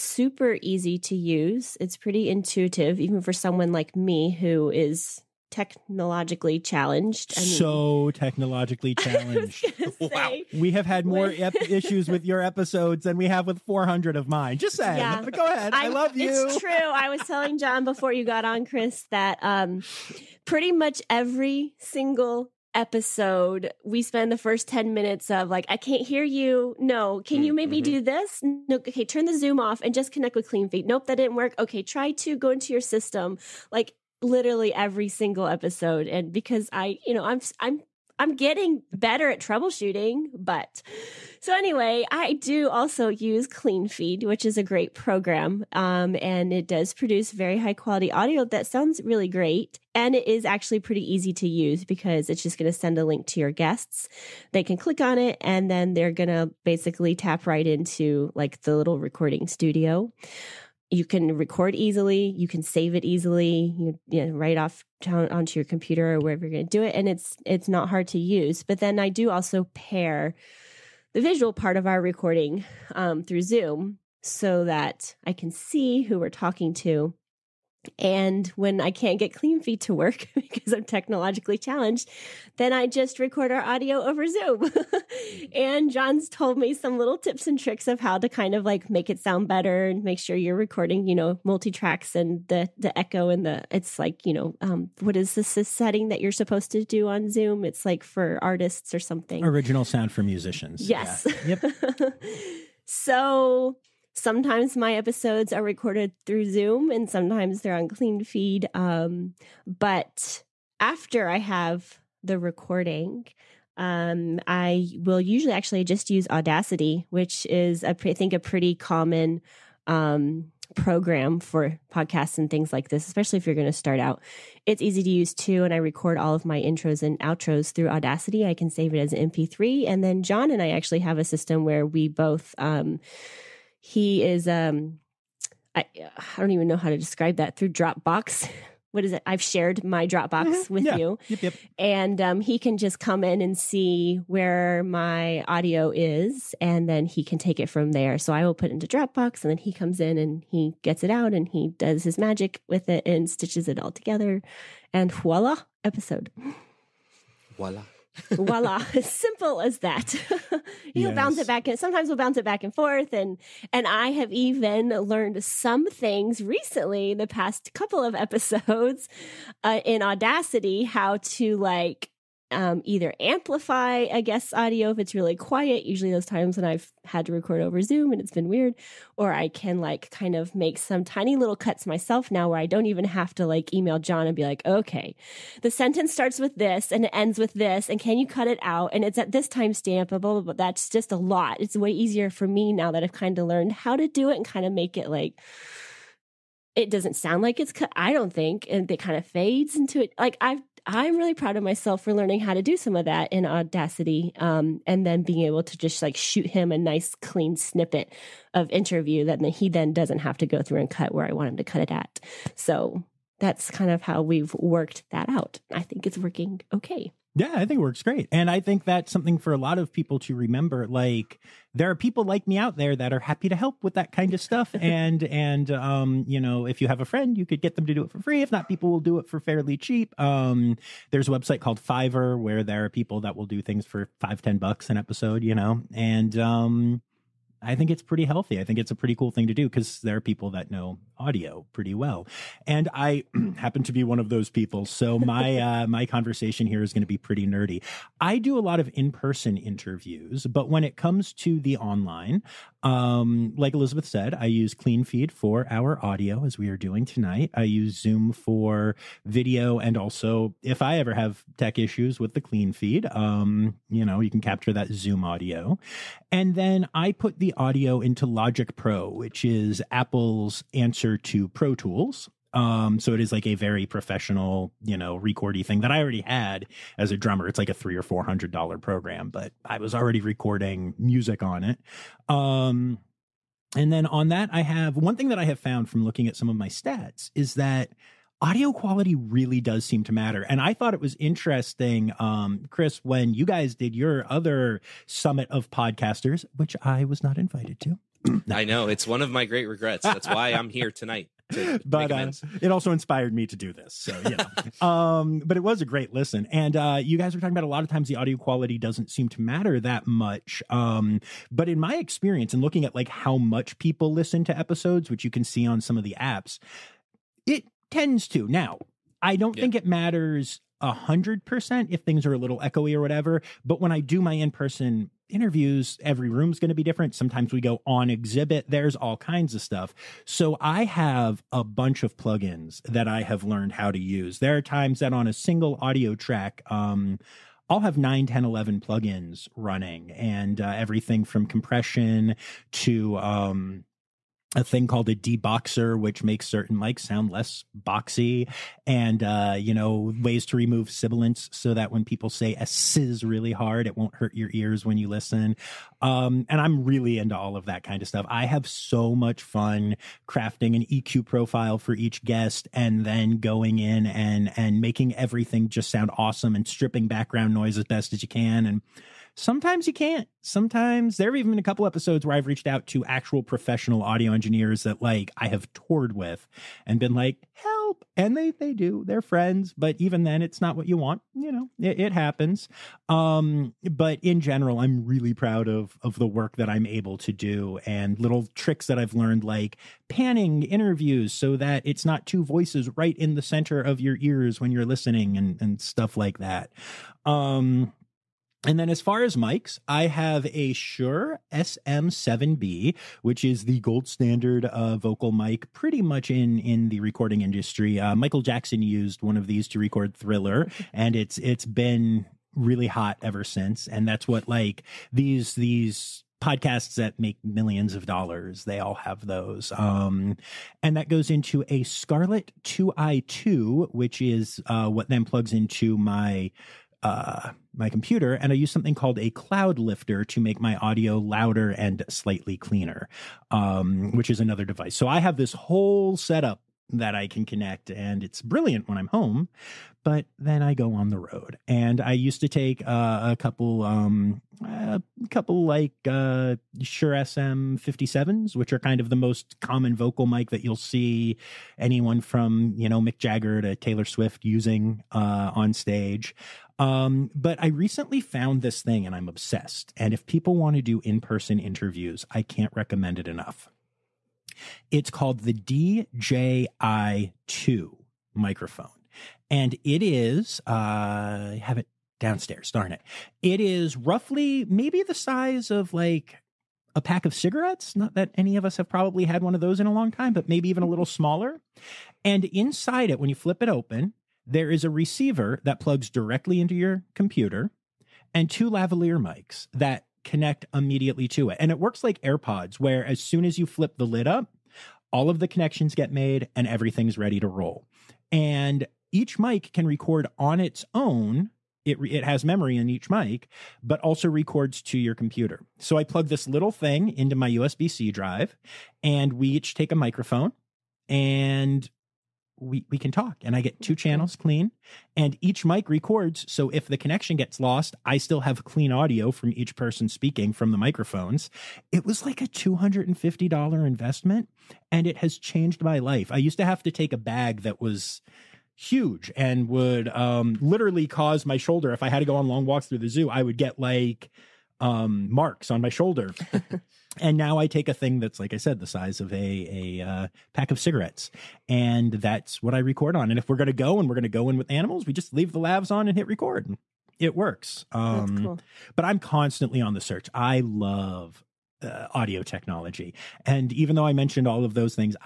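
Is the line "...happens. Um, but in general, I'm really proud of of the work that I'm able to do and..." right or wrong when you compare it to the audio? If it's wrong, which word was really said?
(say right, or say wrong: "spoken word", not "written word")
right.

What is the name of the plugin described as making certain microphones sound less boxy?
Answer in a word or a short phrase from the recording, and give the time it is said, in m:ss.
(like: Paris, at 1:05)
deboxer, at 5:45.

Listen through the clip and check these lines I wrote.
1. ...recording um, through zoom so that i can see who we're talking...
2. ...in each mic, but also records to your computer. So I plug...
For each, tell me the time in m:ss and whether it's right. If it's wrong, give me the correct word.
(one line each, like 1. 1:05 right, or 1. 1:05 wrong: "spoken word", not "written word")
1. 1:12 right
2. 8:22 right.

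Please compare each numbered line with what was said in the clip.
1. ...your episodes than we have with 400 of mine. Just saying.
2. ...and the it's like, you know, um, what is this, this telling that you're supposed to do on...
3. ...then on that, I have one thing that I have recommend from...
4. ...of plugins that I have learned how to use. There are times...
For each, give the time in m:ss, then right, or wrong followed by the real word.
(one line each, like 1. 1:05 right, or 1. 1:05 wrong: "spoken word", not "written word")
1. 0:12 right
2. 1:33 wrong: "setting", not "telling"
3. 4:43 wrong: "found", not "recommend"
4. 5:32 right.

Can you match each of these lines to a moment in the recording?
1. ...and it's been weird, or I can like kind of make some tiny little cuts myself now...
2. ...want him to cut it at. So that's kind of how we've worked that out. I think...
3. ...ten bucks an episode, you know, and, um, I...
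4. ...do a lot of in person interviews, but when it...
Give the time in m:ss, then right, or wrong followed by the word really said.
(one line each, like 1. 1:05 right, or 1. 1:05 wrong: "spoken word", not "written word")
1. 2:58 right
2. 3:31 right
3. 3:54 right
4. 4:08 right.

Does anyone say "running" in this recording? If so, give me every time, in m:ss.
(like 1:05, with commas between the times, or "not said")
5:39.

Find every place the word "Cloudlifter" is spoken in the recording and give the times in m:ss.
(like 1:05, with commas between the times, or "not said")
7:09.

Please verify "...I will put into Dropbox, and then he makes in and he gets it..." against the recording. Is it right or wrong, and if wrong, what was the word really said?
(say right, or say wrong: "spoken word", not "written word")
wrong: "comes", not "makes".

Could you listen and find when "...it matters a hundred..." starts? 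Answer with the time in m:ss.
5:19.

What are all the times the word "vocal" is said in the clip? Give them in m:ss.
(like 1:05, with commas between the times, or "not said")
6:44, 7:29.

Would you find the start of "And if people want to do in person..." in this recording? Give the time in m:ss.
7:39.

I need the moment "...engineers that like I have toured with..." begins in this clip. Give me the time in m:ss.
6:14.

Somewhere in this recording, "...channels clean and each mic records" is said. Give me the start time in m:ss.
8:33.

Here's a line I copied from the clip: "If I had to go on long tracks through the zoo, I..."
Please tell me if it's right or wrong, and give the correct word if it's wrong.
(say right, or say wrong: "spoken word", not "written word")
wrong: "walks", not "tracks".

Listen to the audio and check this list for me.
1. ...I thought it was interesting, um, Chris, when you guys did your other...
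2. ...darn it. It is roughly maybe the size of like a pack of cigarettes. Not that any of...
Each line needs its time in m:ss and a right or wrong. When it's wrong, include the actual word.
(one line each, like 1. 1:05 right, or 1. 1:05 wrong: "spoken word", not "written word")
1. 4:50 right
2. 7:52 right.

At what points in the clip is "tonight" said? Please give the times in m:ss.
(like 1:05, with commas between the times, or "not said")
4:17, 5:00.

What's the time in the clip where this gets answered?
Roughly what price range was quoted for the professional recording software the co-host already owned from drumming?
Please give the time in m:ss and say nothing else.
4:37.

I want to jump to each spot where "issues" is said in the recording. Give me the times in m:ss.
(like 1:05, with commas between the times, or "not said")
0:11, 4:21.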